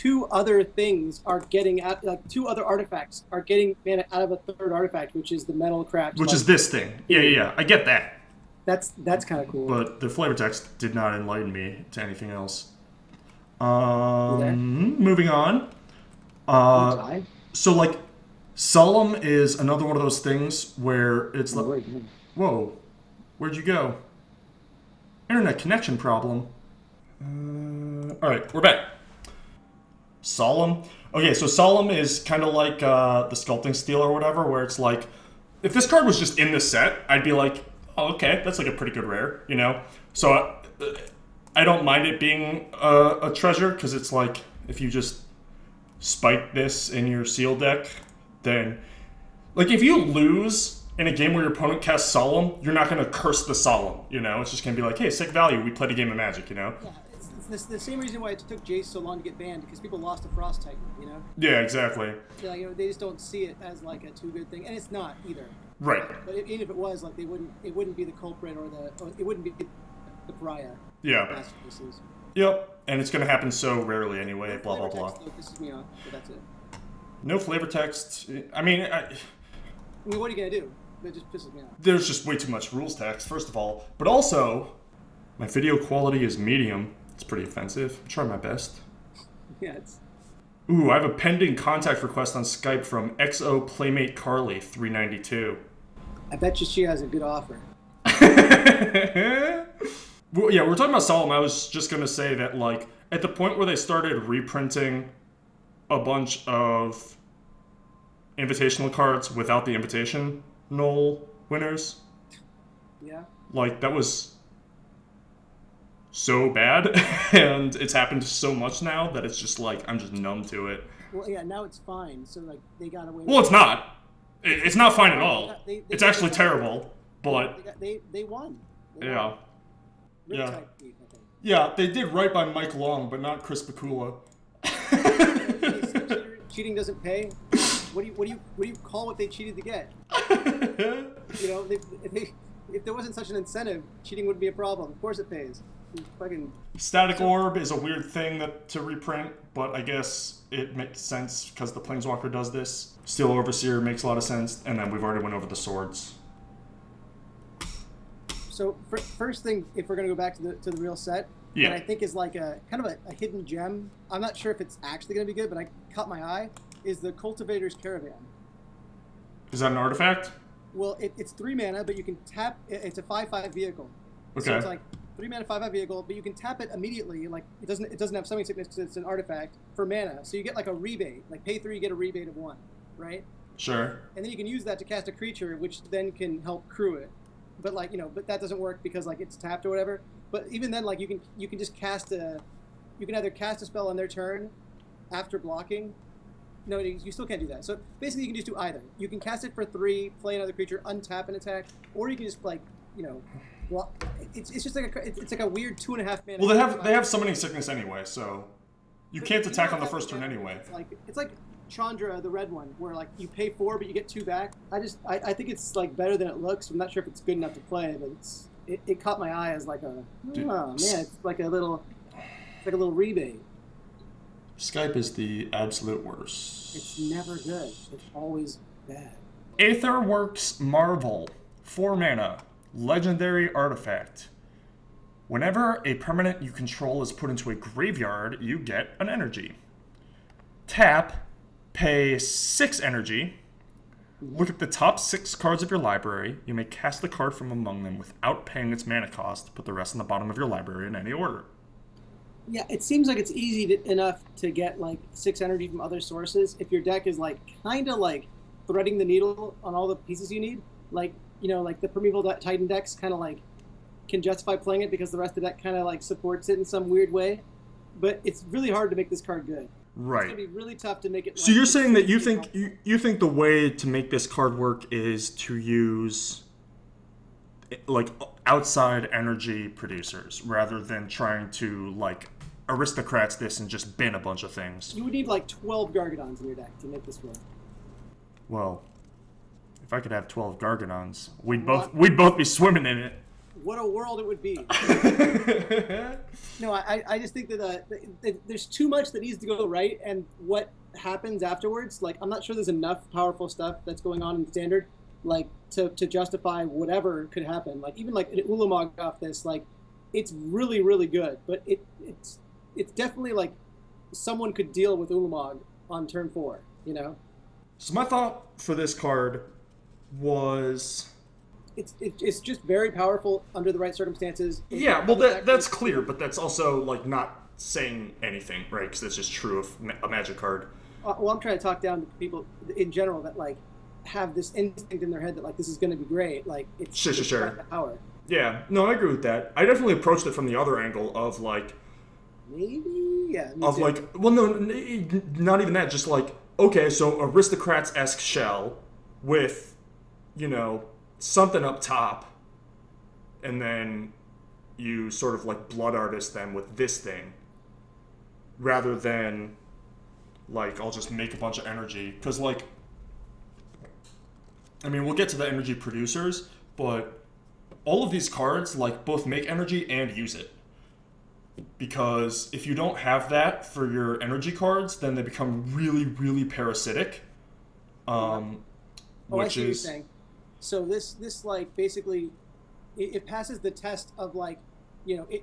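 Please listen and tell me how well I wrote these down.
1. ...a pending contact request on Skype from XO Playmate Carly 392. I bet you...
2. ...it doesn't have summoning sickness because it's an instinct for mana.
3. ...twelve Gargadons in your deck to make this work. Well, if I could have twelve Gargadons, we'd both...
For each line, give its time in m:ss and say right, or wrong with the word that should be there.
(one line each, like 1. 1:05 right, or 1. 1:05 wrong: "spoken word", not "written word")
1. 1:31 right
2. 2:57 wrong: "artifact", not "instinct"
3. 4:45 right.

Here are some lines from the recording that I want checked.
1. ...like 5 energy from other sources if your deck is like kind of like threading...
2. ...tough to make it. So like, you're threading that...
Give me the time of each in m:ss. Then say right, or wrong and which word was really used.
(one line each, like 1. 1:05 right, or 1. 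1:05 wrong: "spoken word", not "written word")
1. 4:14 wrong: "6", not "5"
2. 4:30 wrong: "saying", not "threading".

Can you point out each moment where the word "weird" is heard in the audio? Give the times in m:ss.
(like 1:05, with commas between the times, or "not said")
2:27, 3:25, 4:26.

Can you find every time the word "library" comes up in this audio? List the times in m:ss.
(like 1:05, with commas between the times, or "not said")
4:05, 4:10.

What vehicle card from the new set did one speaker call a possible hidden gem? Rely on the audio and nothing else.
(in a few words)
Cultivator's Caravan.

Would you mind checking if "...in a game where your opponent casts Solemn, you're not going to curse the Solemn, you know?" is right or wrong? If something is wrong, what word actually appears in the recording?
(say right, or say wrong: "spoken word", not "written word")
right.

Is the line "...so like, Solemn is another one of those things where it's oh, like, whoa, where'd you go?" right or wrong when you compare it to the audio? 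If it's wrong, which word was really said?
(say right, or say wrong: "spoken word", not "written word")
right.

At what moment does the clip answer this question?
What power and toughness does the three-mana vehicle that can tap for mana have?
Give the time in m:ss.
2:53.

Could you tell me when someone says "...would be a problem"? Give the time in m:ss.
2:24.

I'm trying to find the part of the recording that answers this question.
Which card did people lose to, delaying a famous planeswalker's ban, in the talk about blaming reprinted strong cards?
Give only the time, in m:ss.
1:00.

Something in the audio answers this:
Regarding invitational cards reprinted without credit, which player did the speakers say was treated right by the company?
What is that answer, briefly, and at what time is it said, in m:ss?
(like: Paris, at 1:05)
Mike Long, at 2:12.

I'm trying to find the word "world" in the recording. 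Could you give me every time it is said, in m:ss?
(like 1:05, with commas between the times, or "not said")
4:53.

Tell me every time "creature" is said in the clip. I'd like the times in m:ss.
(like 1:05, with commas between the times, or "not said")
3:05, 3:20.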